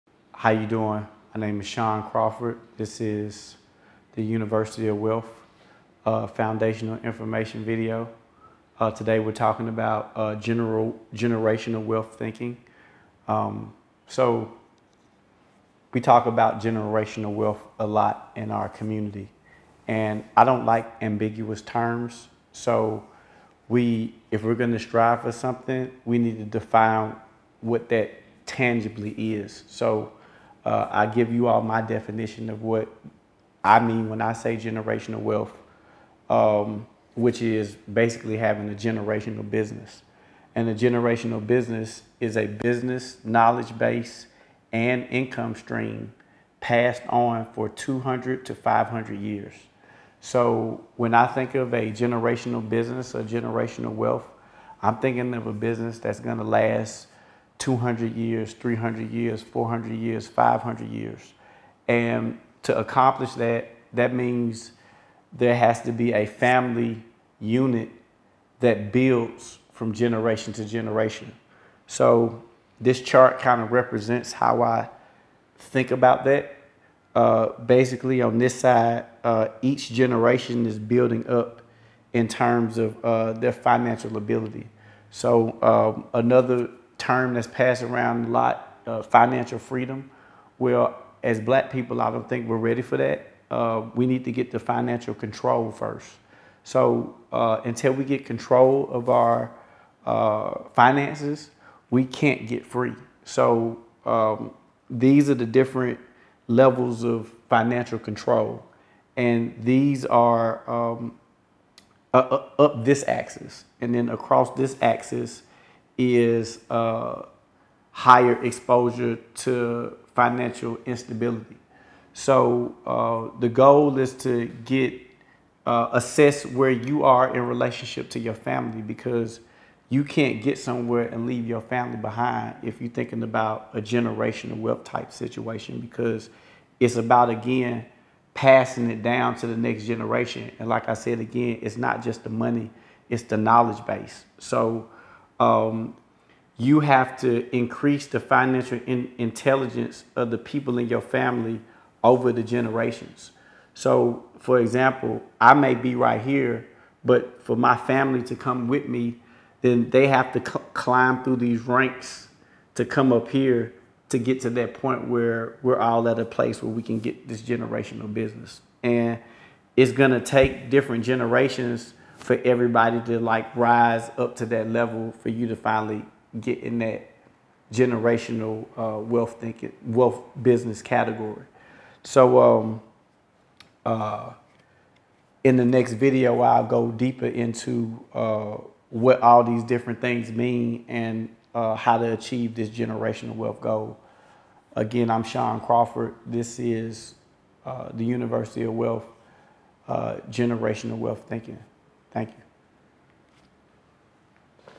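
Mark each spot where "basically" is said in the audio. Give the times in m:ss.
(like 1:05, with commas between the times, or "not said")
0:37, 1:17.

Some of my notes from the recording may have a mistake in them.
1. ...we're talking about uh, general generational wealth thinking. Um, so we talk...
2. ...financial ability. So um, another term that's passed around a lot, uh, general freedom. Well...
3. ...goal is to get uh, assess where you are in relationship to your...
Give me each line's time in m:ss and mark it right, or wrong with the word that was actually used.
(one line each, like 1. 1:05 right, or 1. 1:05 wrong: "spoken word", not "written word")
1. 0:09 right
2. 1:23 wrong: "financial", not "general"
3. 2:03 right.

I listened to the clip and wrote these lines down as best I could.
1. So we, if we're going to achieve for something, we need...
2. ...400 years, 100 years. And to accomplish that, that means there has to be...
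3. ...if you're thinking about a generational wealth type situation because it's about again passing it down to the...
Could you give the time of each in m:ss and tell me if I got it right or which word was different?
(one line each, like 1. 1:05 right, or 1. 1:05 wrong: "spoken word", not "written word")
1. 0:22 wrong: "strive", not "achieve"
2. 0:59 wrong: "500", not "100"
3. 2:12 right.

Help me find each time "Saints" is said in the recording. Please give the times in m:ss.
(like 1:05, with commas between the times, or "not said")
not said.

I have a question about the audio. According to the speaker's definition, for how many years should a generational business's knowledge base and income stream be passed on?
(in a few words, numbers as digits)
200 to 500 years.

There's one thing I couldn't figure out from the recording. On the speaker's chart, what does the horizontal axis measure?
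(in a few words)
higher exposure to financial instability.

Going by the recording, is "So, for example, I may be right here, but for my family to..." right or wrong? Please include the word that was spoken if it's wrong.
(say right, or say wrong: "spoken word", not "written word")
right.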